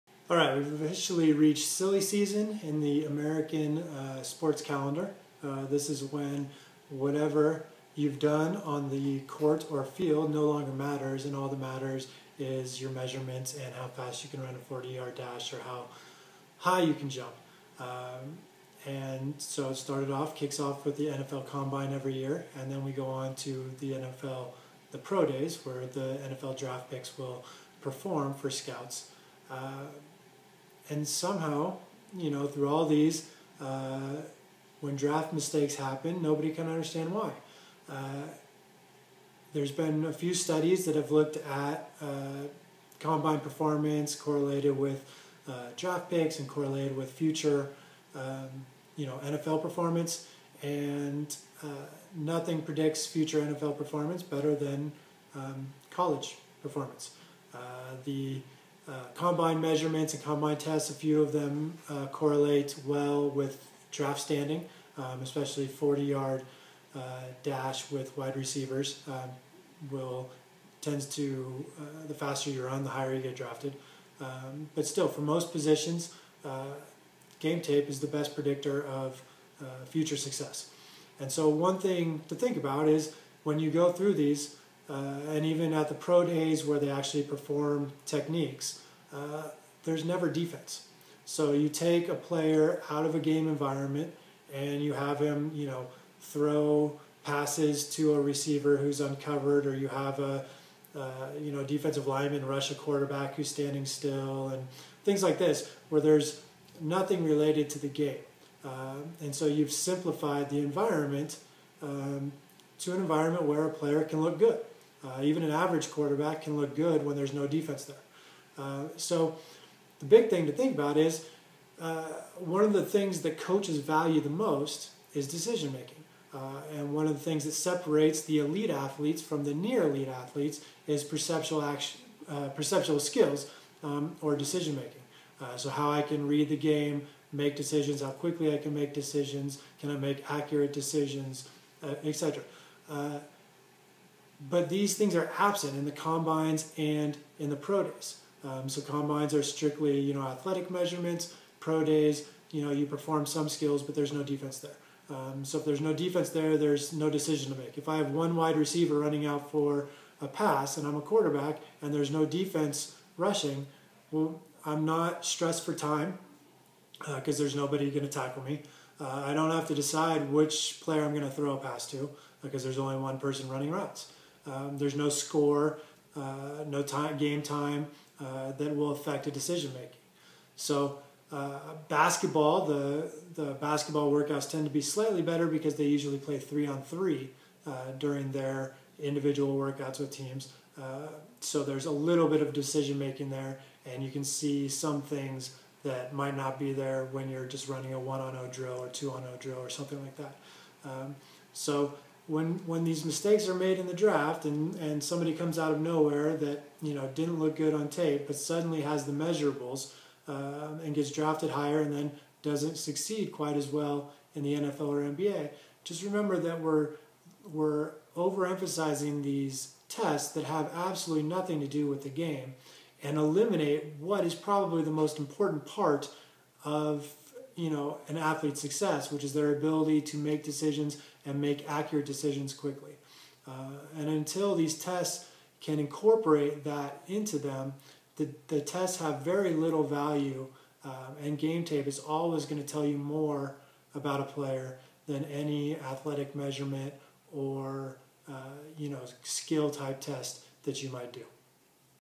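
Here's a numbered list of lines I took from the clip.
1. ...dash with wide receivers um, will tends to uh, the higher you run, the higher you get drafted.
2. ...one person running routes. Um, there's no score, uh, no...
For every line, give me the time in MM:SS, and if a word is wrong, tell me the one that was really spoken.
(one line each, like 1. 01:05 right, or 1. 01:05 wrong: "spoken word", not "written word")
1. 01:07 wrong: "faster", not "higher"
2. 02:52 right.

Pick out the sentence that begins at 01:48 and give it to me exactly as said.
Uh, and so you've simplified the environment um, to an environment where a player can look good.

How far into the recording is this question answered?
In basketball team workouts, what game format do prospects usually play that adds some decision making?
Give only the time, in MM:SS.
03:06.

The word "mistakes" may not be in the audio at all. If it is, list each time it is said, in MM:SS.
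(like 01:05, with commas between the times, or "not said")
00:35, 03:23.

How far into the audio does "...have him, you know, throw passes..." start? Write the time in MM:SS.
01:34.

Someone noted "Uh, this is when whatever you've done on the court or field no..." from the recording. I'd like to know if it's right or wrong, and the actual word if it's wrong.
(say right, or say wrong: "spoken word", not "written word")
right.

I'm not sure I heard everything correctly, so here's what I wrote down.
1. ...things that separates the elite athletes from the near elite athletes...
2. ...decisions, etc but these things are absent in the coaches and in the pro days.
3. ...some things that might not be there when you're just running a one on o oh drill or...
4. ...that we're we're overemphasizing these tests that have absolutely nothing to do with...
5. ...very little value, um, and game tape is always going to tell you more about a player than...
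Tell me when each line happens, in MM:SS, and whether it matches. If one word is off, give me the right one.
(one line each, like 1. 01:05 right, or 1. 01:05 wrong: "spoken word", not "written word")
1. 02:07 right
2. 02:20 wrong: "combines", not "coaches"
3. 03:14 right
4. 03:36 right
5. 03:59 right.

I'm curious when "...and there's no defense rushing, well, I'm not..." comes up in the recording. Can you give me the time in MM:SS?
02:41.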